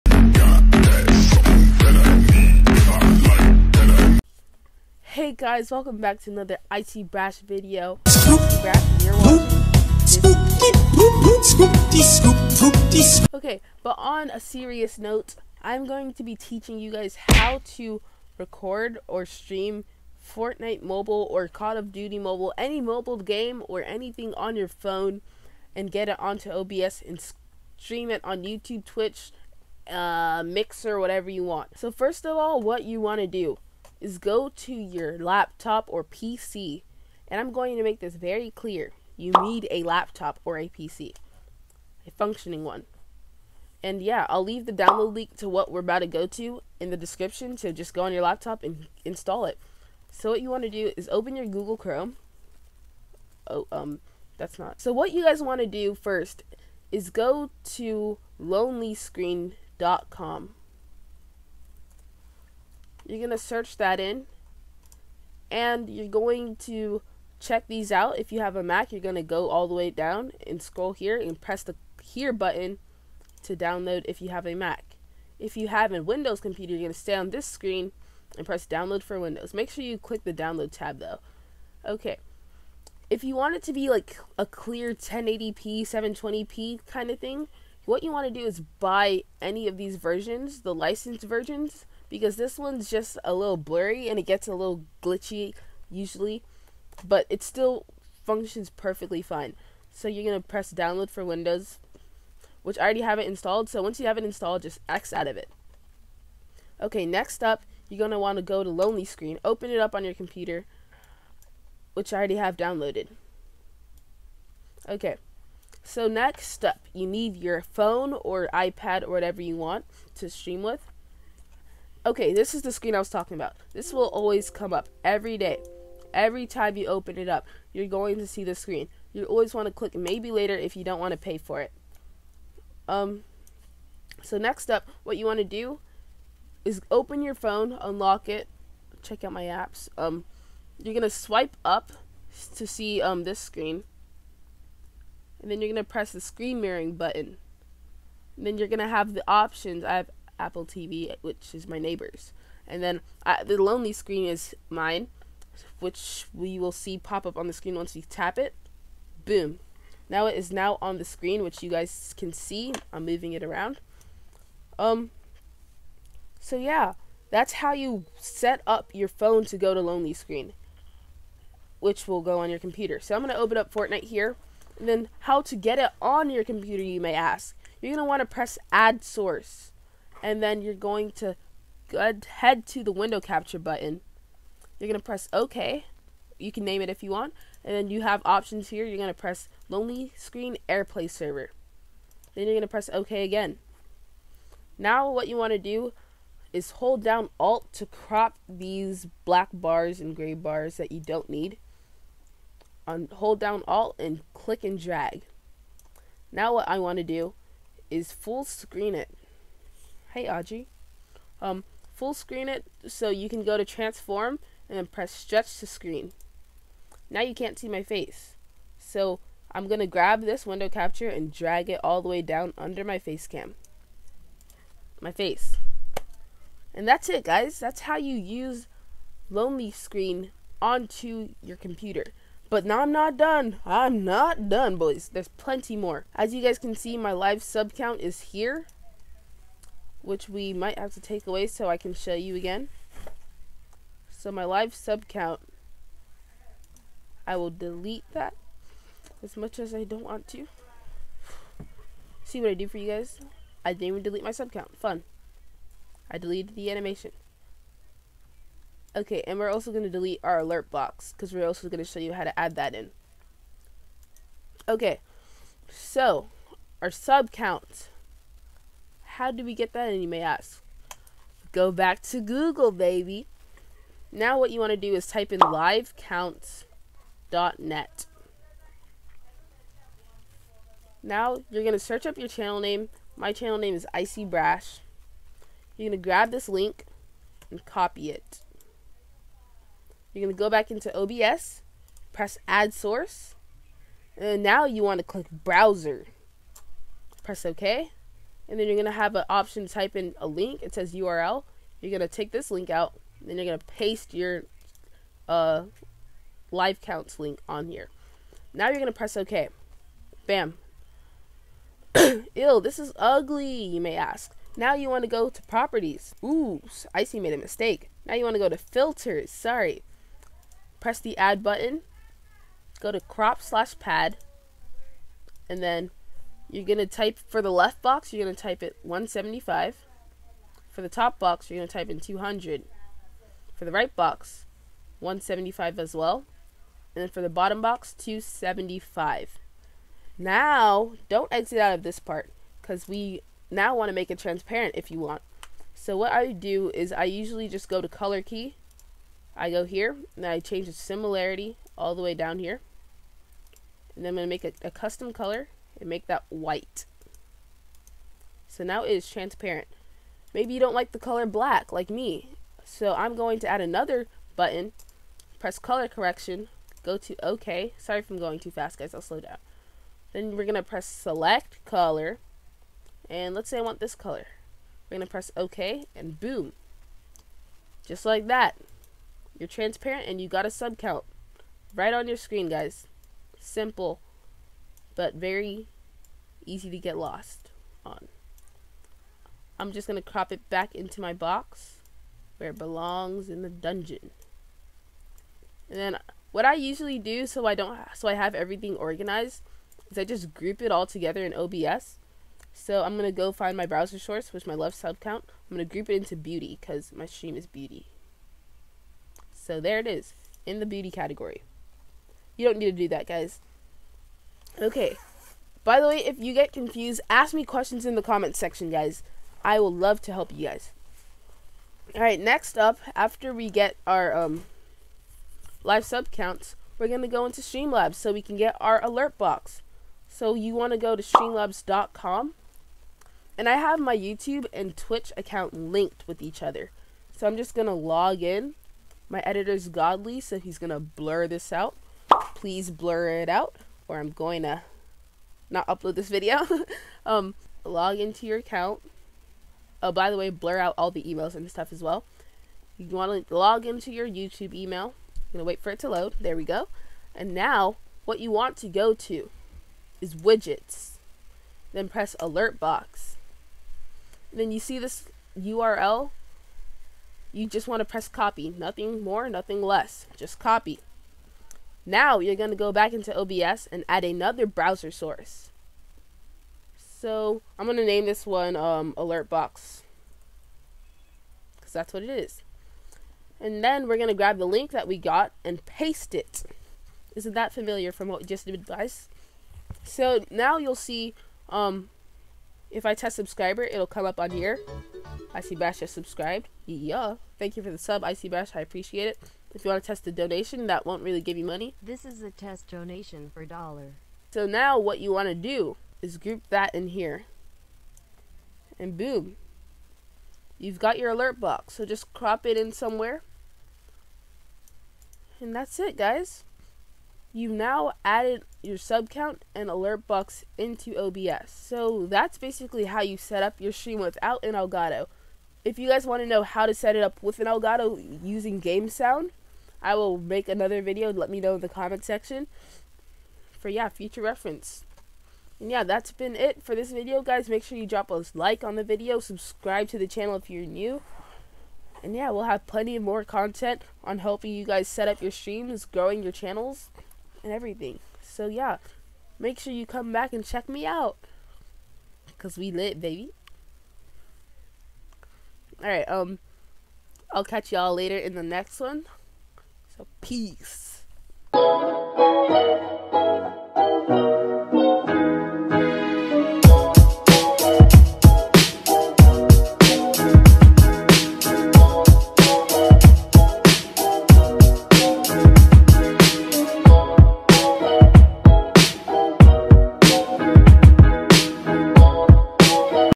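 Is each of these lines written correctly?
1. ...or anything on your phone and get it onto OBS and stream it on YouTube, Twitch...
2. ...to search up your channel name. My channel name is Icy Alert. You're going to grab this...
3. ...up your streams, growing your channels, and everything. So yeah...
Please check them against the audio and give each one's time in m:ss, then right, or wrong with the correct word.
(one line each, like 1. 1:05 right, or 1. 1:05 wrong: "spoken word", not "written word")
1. 0:23 right
2. 4:41 wrong: "Brash", not "Alert"
3. 9:05 right.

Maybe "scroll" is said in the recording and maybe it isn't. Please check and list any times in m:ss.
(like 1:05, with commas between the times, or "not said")
1:10.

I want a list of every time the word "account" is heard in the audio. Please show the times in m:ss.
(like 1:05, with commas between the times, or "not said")
7:15, 7:28.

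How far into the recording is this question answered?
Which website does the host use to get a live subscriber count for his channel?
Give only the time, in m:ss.
4:35.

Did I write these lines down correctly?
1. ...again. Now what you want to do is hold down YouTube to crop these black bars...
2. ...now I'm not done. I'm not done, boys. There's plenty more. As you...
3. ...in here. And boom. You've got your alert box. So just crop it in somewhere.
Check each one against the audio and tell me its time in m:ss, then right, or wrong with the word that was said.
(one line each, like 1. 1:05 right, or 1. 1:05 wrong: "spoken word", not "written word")
1. 3:13 wrong: "Alt", not "YouTube"
2. 3:52 right
3. 8:26 right.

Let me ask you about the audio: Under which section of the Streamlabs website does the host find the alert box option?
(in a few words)
Widgets.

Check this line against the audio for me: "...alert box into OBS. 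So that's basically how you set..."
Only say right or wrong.
right.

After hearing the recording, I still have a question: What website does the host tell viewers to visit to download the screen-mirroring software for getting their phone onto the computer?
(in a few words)
lonelyscreen.com.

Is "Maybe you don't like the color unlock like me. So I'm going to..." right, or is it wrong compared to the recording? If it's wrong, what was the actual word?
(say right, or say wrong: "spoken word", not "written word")
wrong: "black", not "unlock".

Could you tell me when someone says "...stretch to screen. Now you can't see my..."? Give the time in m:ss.
3:35.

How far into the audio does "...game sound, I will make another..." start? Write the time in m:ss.
8:48.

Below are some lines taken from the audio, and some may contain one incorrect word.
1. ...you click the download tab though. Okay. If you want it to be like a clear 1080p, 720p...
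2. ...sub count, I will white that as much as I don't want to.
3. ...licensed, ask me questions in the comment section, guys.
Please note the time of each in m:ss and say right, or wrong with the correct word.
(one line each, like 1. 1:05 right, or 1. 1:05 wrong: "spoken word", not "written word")
1. 1:19 right
2. 4:04 wrong: "delete", not "white"
3. 6:56 wrong: "confused", not "licensed".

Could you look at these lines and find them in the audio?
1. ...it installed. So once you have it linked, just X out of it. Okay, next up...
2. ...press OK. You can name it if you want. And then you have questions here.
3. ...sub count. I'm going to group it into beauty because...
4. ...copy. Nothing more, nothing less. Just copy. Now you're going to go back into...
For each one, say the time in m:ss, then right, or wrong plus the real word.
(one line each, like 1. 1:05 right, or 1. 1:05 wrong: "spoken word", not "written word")
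1. 1:43 wrong: "installed", not "linked"
2. 3:05 wrong: "options", not "questions"
3. 6:44 right
4. 7:48 right.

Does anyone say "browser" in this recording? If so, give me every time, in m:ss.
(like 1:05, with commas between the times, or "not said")
4:55, 6:43, 7:54.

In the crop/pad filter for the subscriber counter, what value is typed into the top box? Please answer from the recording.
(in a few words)
200.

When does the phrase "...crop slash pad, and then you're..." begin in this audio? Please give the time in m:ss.
5:22.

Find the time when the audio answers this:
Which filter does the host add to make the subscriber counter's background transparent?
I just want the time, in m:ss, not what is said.
5:47.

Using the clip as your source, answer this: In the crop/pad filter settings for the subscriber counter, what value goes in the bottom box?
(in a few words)
275.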